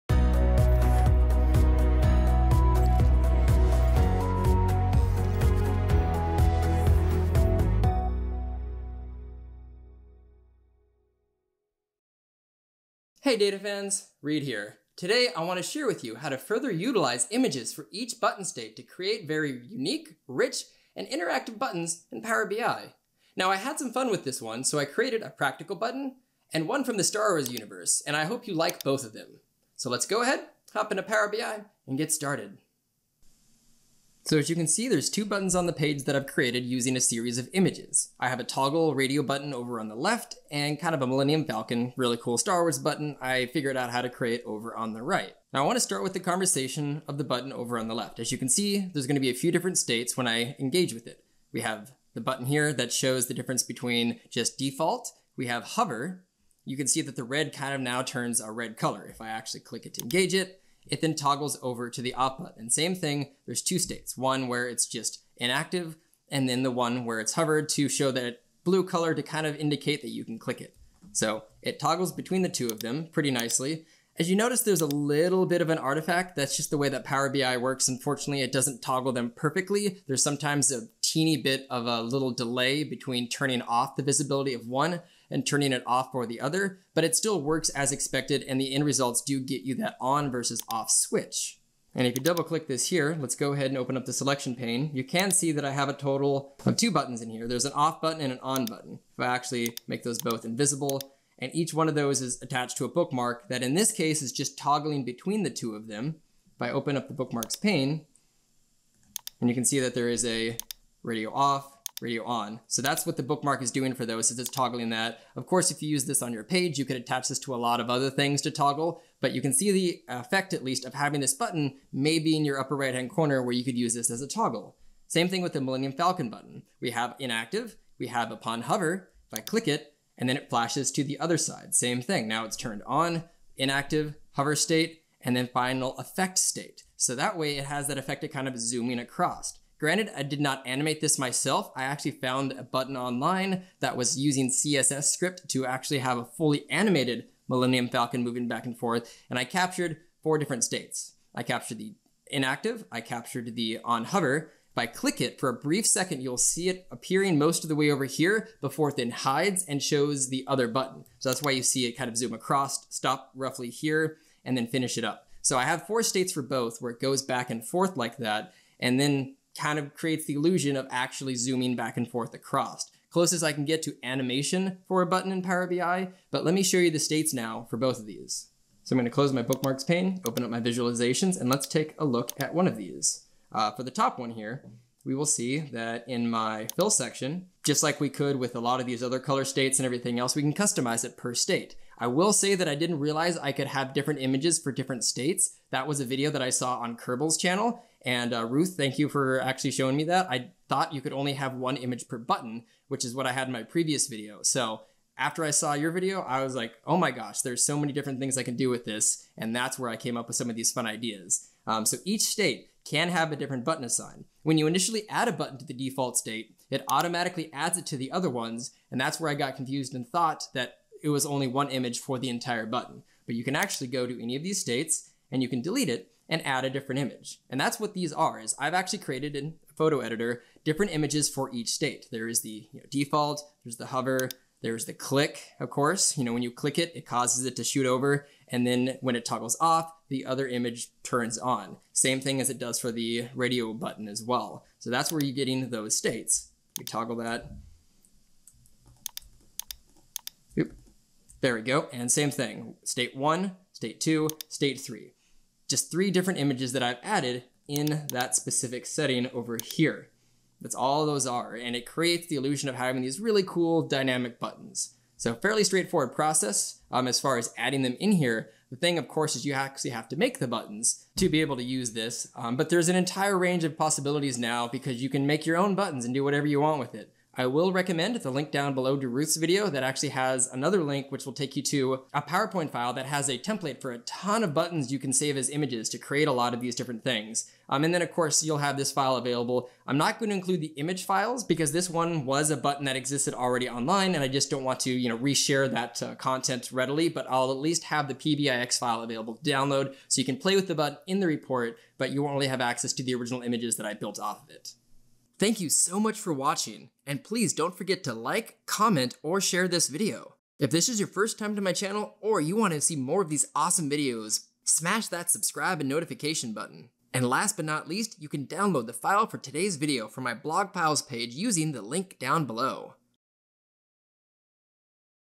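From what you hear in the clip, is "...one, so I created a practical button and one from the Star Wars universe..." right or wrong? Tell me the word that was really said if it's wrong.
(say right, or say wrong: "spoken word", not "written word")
right.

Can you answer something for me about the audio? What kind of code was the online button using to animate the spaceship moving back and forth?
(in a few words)
CSS.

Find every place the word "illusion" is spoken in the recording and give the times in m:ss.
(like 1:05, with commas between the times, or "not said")
2:50, 4:22.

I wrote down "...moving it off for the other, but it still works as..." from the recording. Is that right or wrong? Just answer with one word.
wrong.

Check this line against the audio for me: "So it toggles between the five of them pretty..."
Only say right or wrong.
wrong.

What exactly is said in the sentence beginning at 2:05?
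Same thing with the Millennium Falcon button.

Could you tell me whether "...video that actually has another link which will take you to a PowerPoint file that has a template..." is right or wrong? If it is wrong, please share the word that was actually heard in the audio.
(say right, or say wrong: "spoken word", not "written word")
right.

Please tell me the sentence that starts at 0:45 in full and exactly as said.
Now I want to start with the conversation of the button over on the left.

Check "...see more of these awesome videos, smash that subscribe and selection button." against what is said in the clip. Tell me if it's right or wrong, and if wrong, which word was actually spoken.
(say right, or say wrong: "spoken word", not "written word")
wrong: "notification", not "selection".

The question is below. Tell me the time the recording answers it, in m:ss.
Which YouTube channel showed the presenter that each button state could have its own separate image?
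3:16.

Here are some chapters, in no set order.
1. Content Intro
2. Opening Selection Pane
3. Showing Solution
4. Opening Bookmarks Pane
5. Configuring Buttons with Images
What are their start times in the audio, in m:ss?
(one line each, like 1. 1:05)
1. 0:12
2. 1:33
3. 0:33
4. 1:45
5. 2:57.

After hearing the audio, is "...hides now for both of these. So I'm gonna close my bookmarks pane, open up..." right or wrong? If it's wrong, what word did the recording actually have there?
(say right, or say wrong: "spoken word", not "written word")
wrong: "states", not "hides".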